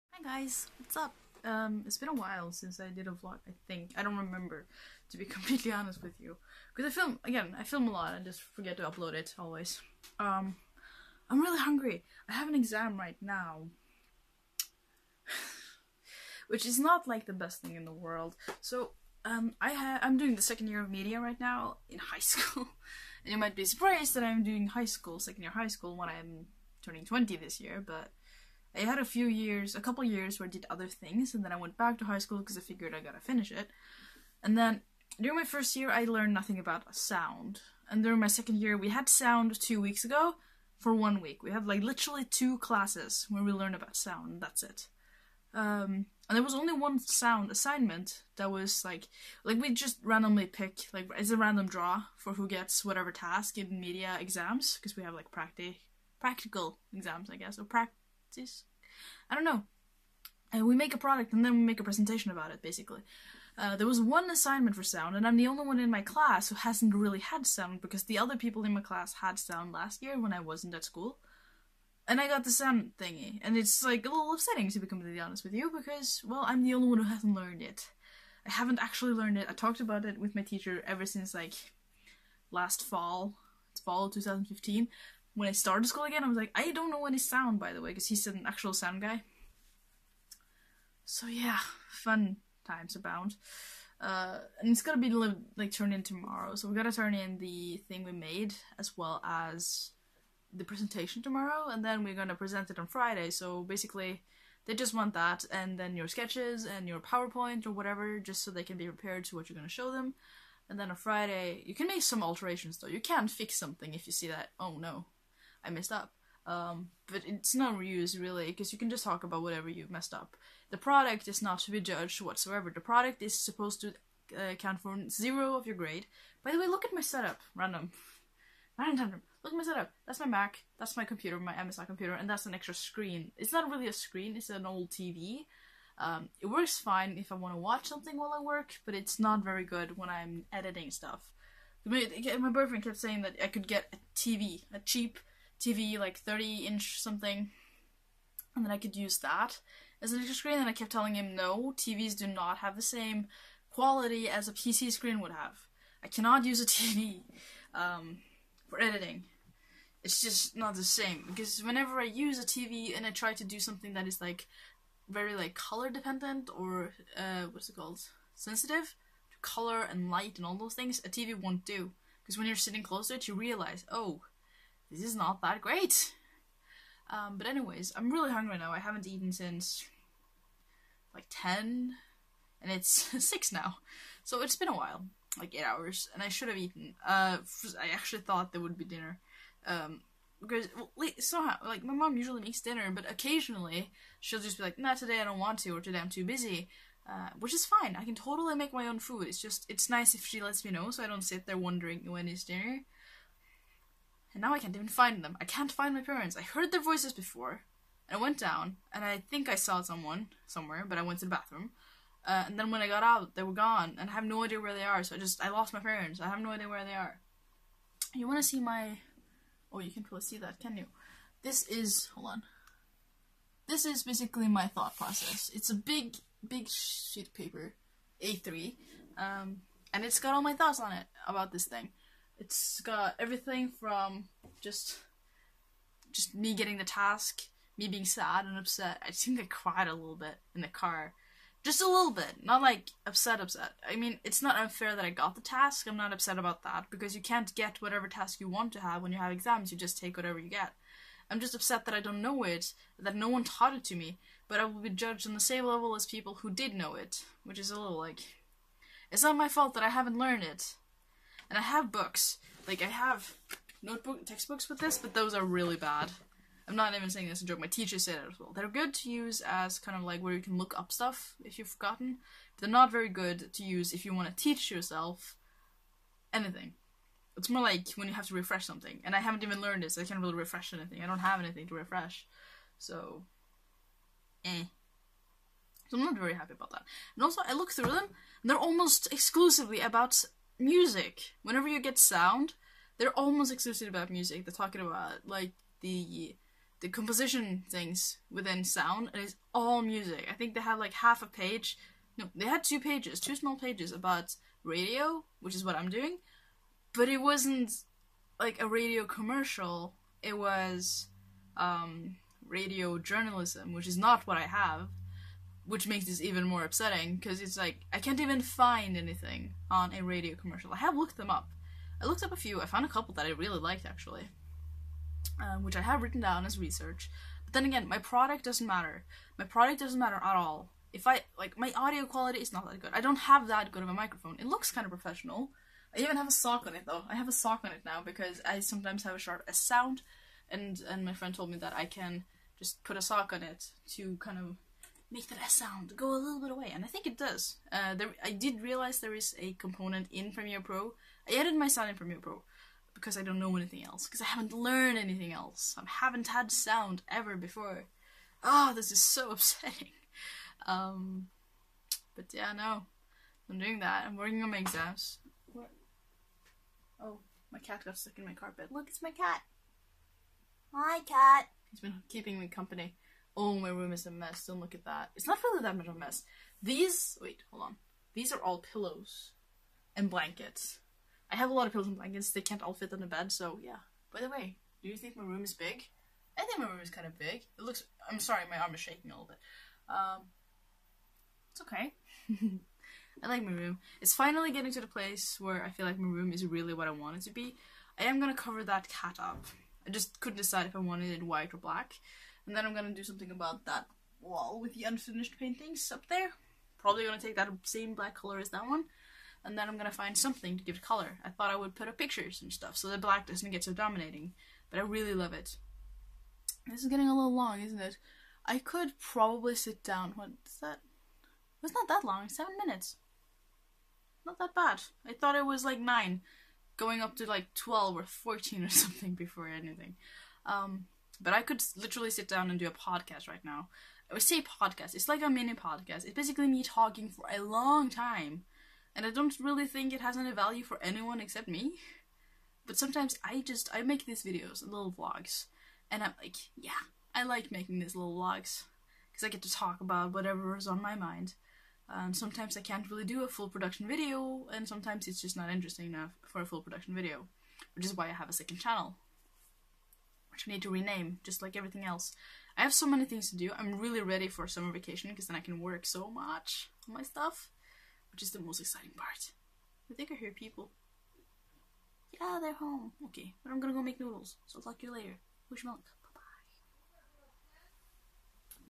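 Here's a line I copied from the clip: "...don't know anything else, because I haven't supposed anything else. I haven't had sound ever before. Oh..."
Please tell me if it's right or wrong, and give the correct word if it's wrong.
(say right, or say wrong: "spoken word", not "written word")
wrong: "learned", not "supposed".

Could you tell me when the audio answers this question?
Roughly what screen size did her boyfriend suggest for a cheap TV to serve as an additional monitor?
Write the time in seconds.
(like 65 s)
146 s.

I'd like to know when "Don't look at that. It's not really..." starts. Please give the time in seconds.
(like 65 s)
374 s.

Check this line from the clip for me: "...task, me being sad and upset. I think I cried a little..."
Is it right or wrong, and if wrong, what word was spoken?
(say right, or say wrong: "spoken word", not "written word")
right.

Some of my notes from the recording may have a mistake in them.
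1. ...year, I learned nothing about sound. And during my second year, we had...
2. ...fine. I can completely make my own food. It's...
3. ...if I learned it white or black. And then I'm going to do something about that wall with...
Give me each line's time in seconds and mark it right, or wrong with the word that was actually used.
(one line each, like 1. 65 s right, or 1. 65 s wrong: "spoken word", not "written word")
1. 35 s right
2. 197 s wrong: "totally", not "completely"
3. 400 s wrong: "wanted", not "learned".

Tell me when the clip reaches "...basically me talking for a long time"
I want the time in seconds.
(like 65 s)
436 s.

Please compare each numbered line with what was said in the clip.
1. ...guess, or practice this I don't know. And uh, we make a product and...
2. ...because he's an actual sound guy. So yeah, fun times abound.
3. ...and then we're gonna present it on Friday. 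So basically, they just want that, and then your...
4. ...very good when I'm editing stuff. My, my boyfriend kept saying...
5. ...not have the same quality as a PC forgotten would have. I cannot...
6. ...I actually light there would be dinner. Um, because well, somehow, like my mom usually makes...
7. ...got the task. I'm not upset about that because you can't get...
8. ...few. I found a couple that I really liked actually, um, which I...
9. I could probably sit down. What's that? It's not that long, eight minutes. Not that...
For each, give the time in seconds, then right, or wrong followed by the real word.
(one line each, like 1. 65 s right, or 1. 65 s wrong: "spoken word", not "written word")
1. 57 s right
2. 87 s right
3. 101 s right
4. 139 s right
5. 152 s wrong: "screen", not "forgotten"
6. 187 s wrong: "thought", not "light"
7. 245 s right
8. 322 s right
9. 418 s wrong: "seven", not "eight".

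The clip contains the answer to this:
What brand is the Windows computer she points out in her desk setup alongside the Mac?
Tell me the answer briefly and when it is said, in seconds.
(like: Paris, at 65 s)
MSI, at 131 s.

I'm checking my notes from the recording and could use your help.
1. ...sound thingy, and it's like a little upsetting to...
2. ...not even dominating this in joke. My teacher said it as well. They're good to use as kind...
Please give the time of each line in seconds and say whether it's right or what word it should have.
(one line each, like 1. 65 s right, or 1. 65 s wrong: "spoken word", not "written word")
1. 72 s right
2. 266 s wrong: "saying", not "dominating".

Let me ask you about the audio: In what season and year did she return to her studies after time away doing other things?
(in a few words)
fall 2015.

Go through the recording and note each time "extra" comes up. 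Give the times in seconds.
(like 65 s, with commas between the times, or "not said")
132 s, 150 s.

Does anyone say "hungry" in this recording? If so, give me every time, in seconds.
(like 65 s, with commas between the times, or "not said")
11 s, 178 s.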